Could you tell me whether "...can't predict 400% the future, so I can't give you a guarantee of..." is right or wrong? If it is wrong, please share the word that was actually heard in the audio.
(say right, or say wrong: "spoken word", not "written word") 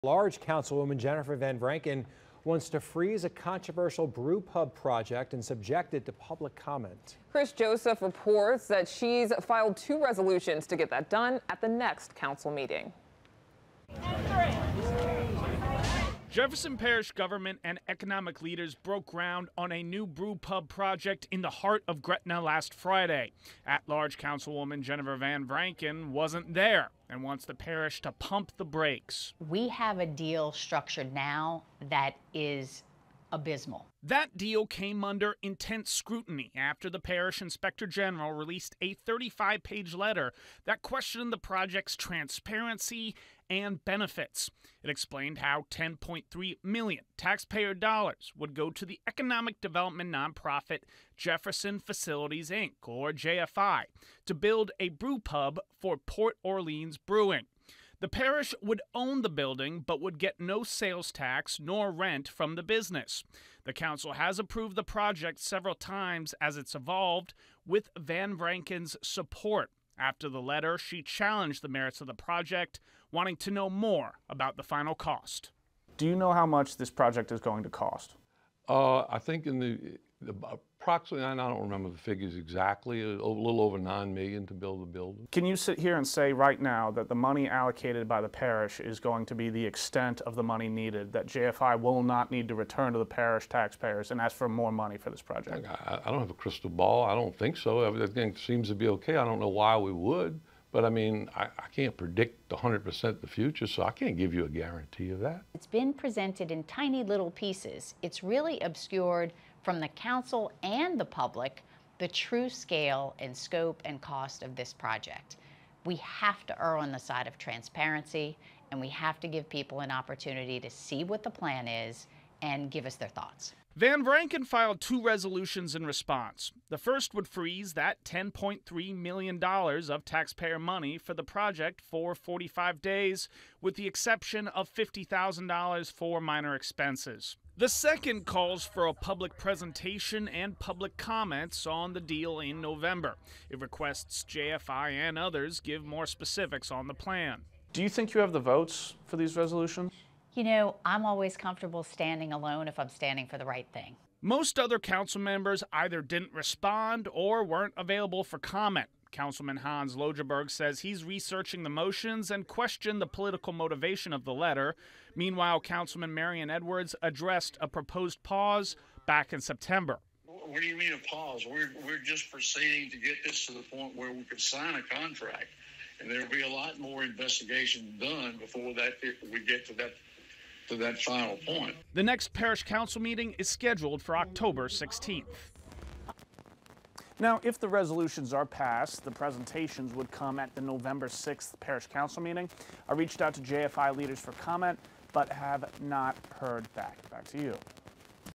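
wrong: "100", not "400".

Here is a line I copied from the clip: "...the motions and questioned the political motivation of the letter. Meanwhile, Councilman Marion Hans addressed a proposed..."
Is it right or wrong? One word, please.
wrong.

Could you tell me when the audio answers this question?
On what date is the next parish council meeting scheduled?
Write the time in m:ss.
3:04.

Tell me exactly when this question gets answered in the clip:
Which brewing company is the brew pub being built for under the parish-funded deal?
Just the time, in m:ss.
0:55.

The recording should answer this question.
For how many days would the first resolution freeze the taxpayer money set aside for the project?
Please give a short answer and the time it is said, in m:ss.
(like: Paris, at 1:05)
45, at 2:12.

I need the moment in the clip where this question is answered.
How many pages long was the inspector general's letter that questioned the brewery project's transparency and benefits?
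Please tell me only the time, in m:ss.
0:38.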